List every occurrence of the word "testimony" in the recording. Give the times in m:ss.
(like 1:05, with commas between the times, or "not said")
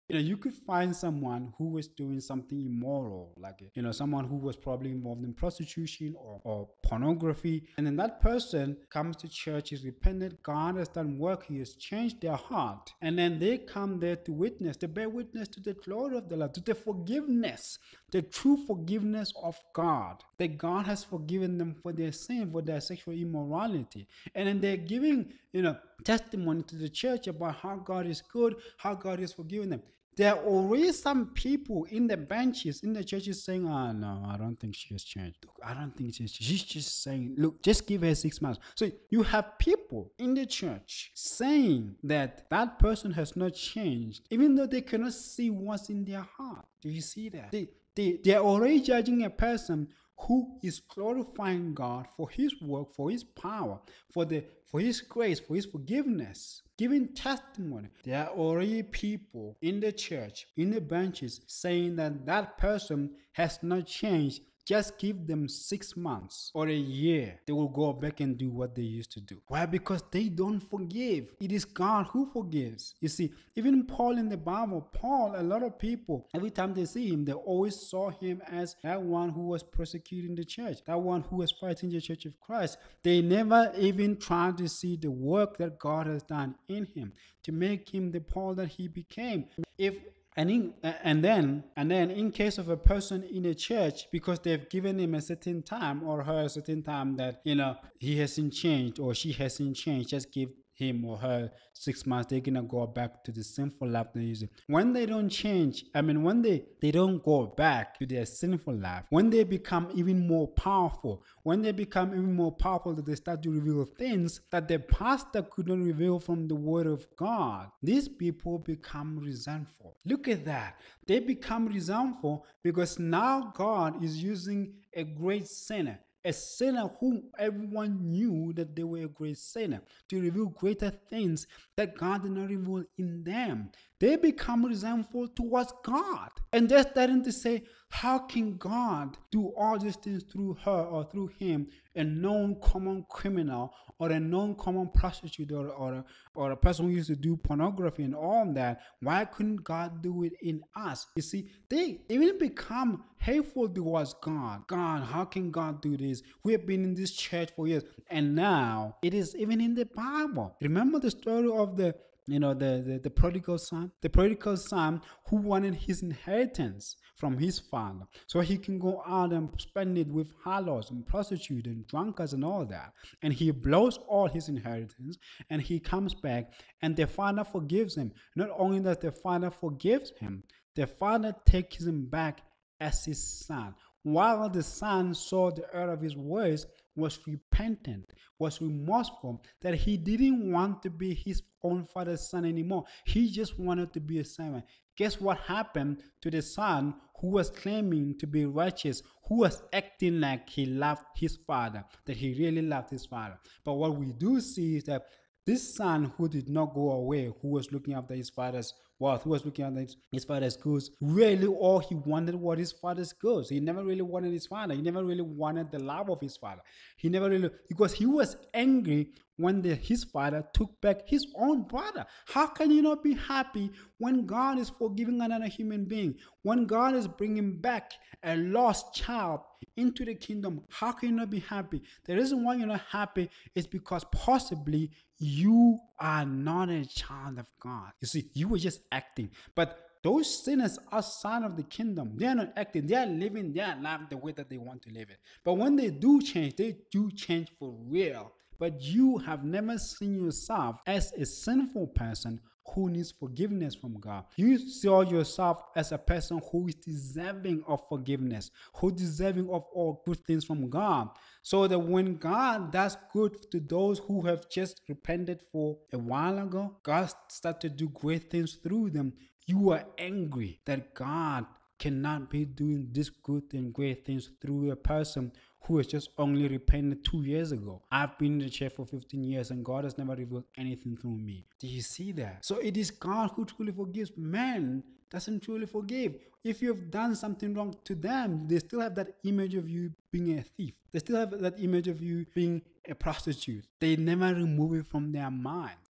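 0:26, 0:57.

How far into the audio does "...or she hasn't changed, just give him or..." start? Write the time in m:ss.
1:38.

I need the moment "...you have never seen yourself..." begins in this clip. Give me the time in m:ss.
4:08.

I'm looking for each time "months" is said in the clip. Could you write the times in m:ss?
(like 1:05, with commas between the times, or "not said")
0:38, 1:05, 1:42.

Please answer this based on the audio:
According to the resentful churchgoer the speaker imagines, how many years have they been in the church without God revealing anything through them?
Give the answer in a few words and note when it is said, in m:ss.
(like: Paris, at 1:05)
15 years, at 4:38.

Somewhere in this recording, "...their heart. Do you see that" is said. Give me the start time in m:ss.
0:46.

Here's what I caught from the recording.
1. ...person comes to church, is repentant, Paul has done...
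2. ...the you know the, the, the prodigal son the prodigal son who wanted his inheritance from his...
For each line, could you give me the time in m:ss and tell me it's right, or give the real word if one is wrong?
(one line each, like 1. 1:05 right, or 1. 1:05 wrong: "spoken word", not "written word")
1. 0:08 wrong: "God", not "Paul"
2. 2:41 right.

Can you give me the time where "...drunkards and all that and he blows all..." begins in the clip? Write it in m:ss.
2:51.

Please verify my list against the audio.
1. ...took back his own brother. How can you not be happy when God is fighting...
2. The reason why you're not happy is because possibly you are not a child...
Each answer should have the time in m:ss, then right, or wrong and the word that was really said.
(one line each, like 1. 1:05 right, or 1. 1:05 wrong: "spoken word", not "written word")
1. 3:40 wrong: "forgiving", not "fighting"
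2. 3:52 right.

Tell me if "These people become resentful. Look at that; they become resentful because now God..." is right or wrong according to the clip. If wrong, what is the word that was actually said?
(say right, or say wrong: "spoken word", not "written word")
right.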